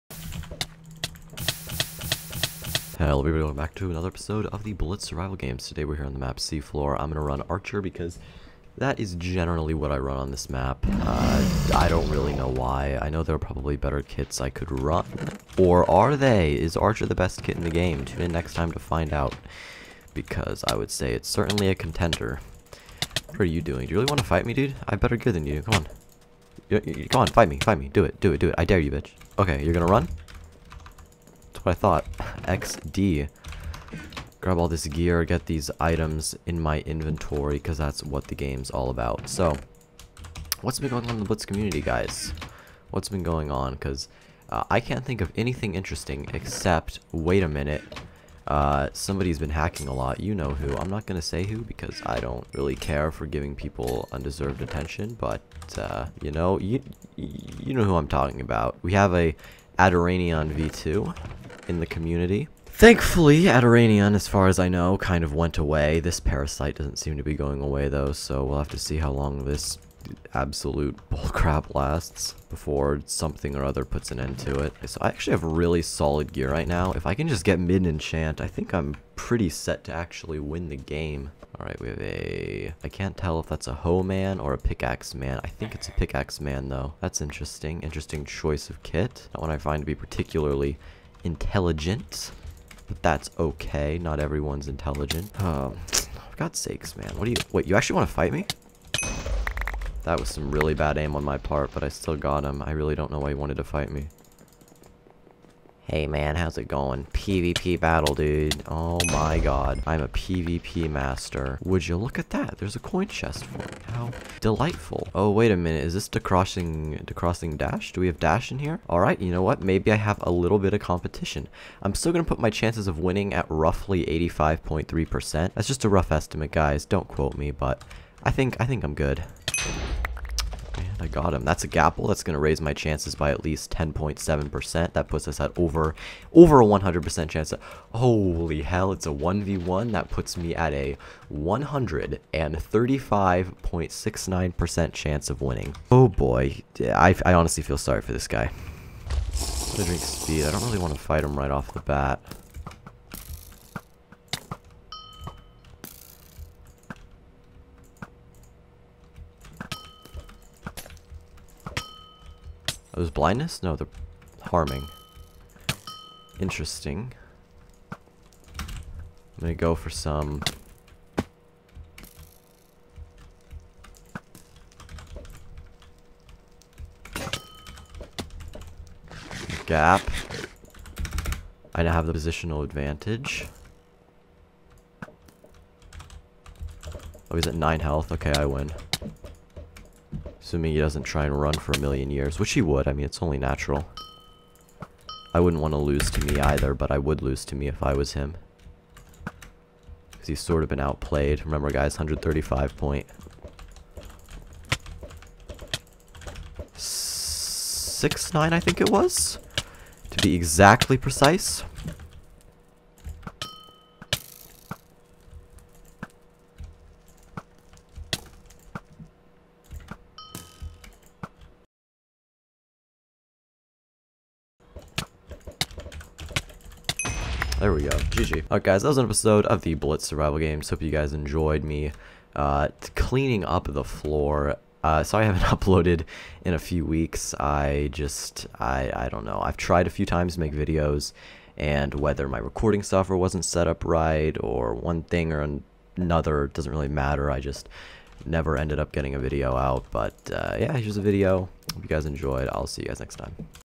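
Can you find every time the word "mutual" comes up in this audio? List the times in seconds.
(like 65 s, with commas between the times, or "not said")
not said.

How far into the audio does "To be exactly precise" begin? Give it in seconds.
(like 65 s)
210 s.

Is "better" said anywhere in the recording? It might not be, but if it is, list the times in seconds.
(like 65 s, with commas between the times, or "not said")
13 s, 24 s.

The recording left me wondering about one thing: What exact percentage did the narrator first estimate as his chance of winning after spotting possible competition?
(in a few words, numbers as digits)
85.3%.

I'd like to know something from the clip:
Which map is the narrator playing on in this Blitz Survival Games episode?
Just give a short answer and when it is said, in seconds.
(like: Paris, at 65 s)
Seafloor, at 6 s.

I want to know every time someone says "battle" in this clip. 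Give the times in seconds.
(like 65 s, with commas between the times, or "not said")
107 s.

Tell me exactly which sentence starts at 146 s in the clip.
I, I honestly feel sorry for this guy.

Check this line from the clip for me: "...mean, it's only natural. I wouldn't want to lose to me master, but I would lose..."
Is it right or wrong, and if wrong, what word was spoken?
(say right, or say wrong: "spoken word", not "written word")
wrong: "either", not "master".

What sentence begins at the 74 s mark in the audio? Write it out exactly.
So I actually have really solid gear right now.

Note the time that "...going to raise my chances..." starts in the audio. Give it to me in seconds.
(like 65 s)
132 s.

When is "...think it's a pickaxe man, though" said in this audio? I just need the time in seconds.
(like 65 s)
85 s.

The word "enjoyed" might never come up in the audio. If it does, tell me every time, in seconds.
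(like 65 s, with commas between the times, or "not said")
231 s, 252 s.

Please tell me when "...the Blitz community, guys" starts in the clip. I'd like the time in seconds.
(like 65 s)
41 s.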